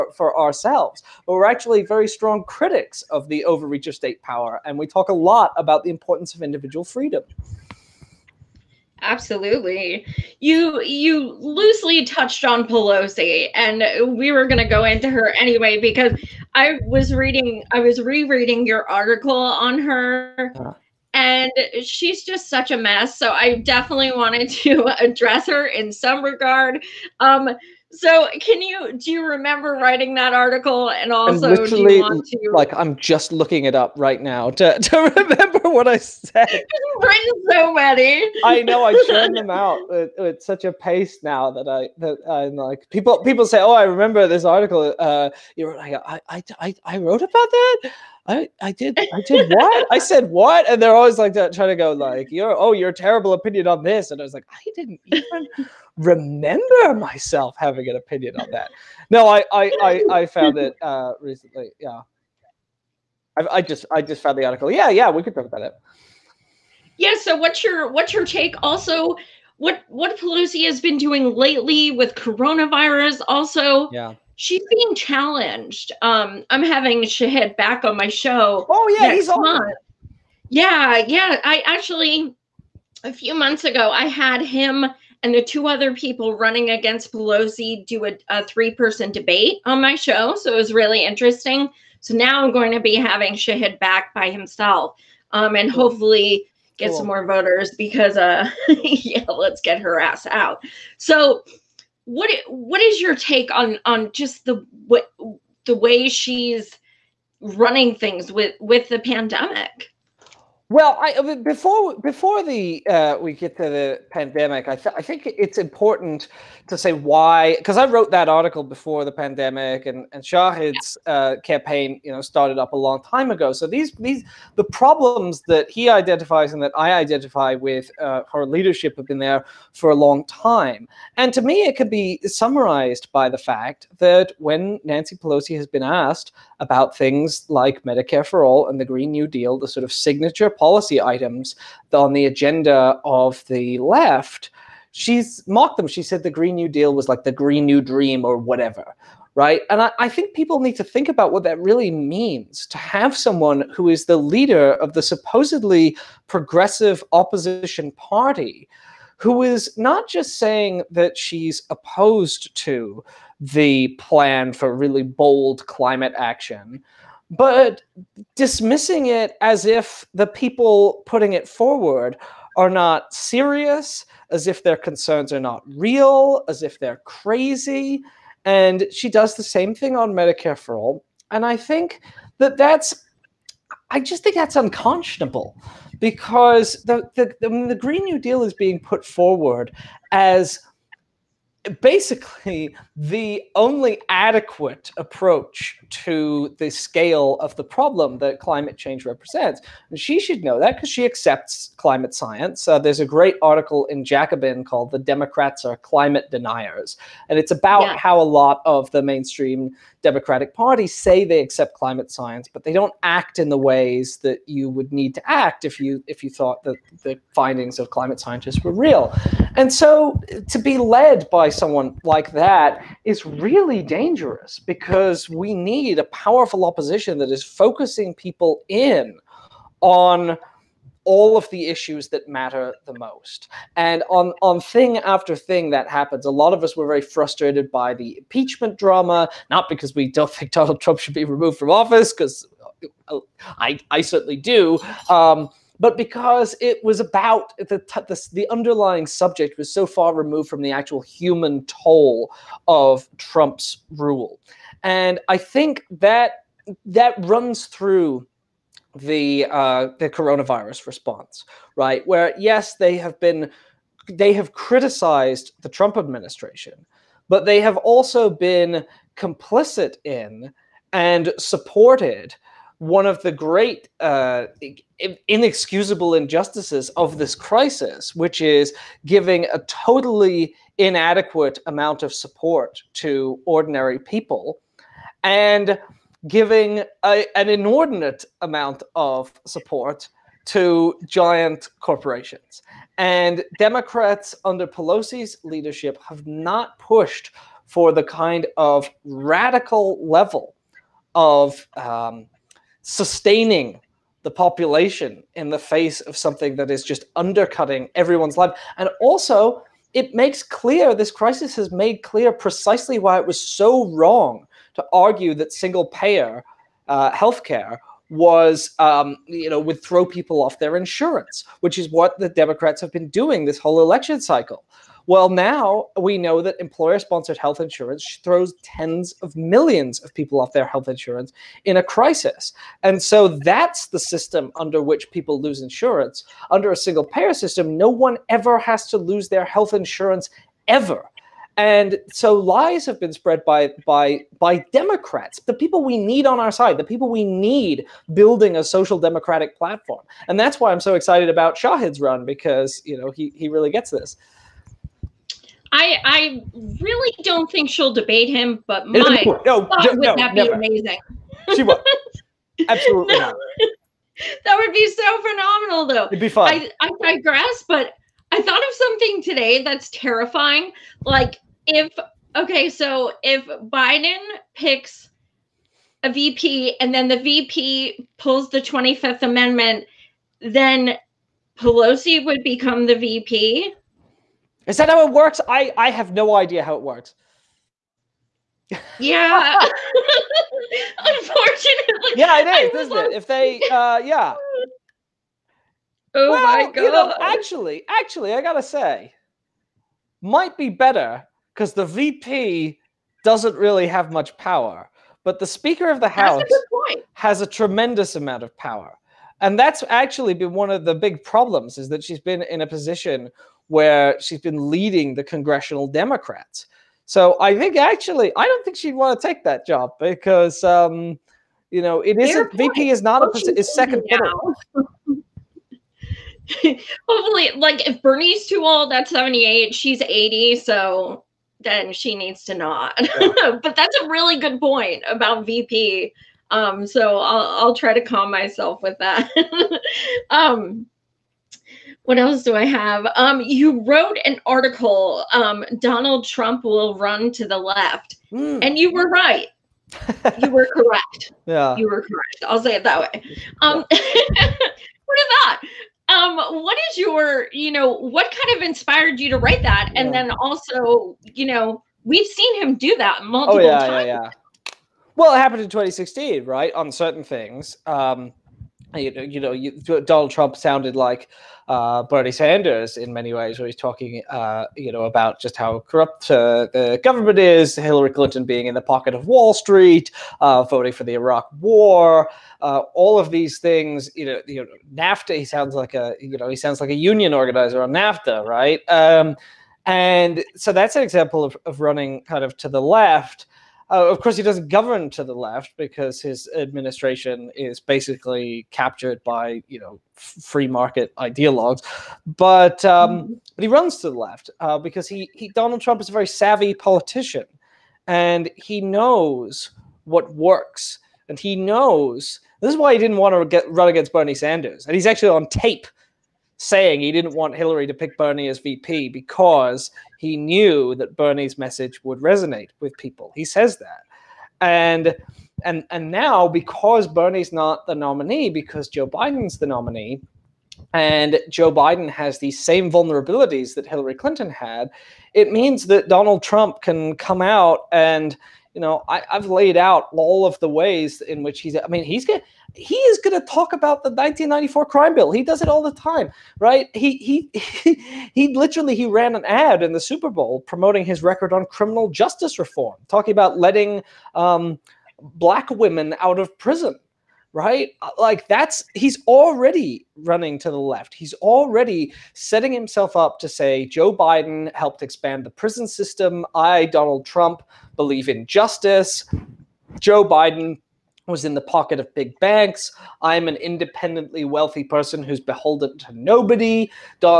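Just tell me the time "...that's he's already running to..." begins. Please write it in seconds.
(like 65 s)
558 s.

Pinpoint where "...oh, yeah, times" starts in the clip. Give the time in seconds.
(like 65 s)
463 s.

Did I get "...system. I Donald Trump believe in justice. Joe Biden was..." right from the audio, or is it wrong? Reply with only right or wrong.
right.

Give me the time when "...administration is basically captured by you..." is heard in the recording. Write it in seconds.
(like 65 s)
496 s.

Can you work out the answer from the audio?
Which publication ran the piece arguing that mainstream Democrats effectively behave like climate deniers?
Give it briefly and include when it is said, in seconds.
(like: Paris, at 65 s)
Jacobin, at 204 s.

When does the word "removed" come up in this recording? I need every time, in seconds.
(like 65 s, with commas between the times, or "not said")
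241 s, 250 s.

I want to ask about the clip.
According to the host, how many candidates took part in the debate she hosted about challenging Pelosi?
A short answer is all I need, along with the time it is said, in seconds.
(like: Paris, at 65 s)
3, at 88 s.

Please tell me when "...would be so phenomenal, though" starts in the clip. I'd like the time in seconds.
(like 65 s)
364 s.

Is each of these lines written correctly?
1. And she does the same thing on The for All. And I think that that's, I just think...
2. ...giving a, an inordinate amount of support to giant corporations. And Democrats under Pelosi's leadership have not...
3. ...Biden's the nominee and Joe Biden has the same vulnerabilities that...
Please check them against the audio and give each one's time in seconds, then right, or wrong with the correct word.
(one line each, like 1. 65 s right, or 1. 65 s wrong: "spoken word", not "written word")
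1. 178 s wrong: "Medicare", not "The"
2. 286 s right
3. 529 s right.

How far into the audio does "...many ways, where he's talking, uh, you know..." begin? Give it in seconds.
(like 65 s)
473 s.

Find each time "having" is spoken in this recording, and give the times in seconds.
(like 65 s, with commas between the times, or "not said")
57 s, 76 s, 92 s.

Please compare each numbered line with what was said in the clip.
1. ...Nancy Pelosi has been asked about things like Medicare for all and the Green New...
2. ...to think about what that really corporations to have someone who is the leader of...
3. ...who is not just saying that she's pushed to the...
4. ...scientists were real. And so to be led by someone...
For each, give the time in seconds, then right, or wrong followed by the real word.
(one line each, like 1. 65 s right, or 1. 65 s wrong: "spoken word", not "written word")
1. 134 s right
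2. 150 s wrong: "means", not "corporations"
3. 159 s wrong: "opposed", not "pushed"
4. 218 s right.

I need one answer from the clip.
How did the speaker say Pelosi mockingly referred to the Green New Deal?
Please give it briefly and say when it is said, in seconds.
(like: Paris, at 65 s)
Green New Dream, at 147 s.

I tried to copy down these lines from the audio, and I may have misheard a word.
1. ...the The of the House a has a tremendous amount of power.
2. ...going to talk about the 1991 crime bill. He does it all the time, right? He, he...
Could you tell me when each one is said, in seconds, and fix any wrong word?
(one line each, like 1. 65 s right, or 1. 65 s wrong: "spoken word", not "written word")
1. 405 s wrong: "Speaker", not "The"
2. 543 s wrong: "1994", not "1991".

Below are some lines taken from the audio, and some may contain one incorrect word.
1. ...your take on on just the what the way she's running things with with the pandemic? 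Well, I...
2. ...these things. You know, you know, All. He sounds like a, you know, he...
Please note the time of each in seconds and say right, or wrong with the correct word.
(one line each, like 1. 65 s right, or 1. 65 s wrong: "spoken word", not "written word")
1. 103 s right
2. 483 s wrong: "NAFTA", not "All".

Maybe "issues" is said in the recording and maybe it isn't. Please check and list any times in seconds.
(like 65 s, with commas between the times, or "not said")
231 s.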